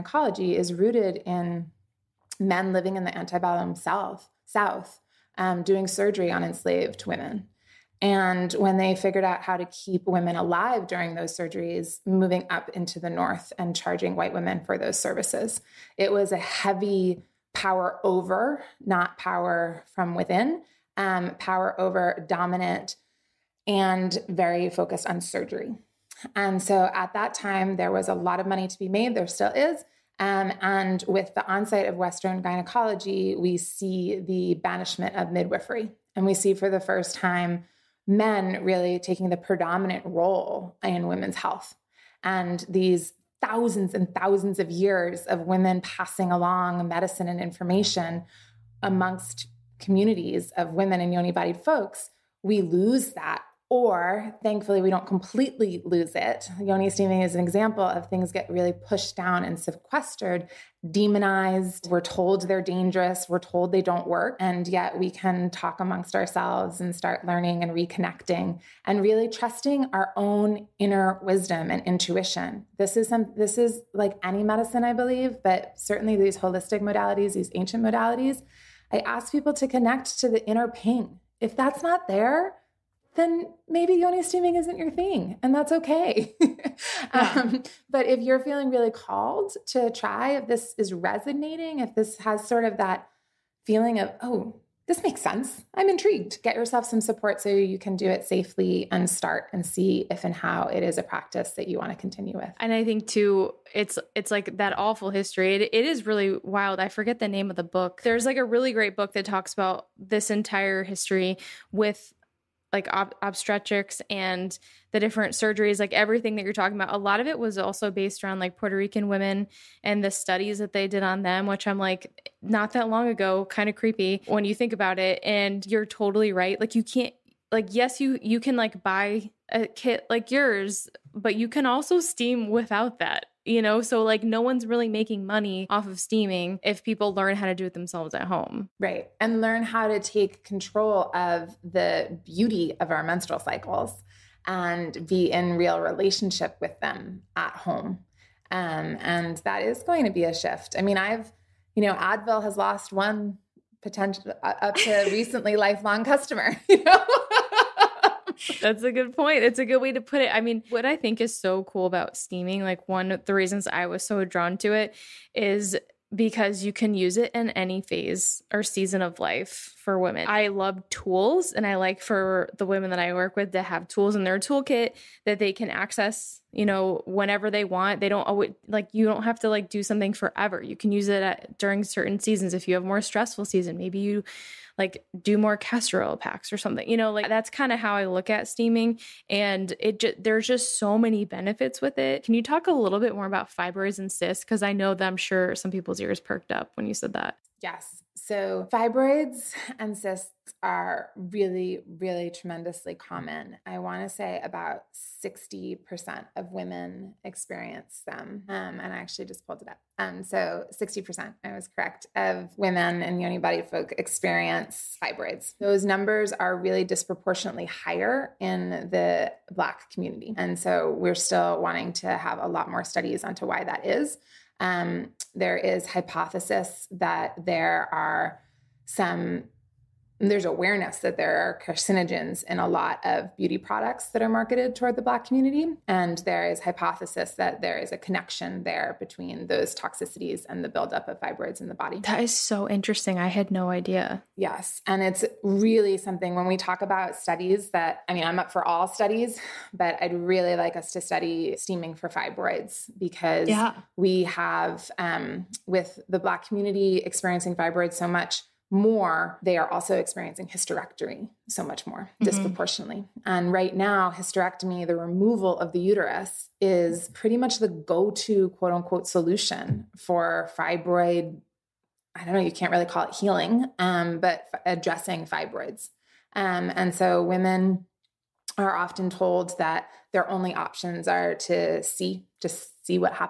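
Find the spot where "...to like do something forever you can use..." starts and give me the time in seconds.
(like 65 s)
179 s.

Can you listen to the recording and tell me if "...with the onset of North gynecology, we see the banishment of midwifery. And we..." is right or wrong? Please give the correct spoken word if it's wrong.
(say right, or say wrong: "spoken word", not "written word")
wrong: "Western", not "North".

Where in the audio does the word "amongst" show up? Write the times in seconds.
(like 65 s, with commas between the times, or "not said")
48 s, 65 s.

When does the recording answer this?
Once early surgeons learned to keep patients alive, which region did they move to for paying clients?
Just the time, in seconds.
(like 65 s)
13 s.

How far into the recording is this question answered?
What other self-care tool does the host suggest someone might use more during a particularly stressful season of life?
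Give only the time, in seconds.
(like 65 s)
185 s.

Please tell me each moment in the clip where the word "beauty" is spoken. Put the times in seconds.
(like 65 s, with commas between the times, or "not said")
142 s, 233 s.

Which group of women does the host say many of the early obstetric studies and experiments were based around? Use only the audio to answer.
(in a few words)
Puerto Rican women.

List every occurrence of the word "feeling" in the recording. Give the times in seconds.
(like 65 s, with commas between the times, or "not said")
88 s, 93 s.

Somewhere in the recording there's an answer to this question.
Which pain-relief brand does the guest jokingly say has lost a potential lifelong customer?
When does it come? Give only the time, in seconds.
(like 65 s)
151 s.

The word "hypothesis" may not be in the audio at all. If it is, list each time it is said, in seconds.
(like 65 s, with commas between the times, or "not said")
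225 s, 236 s.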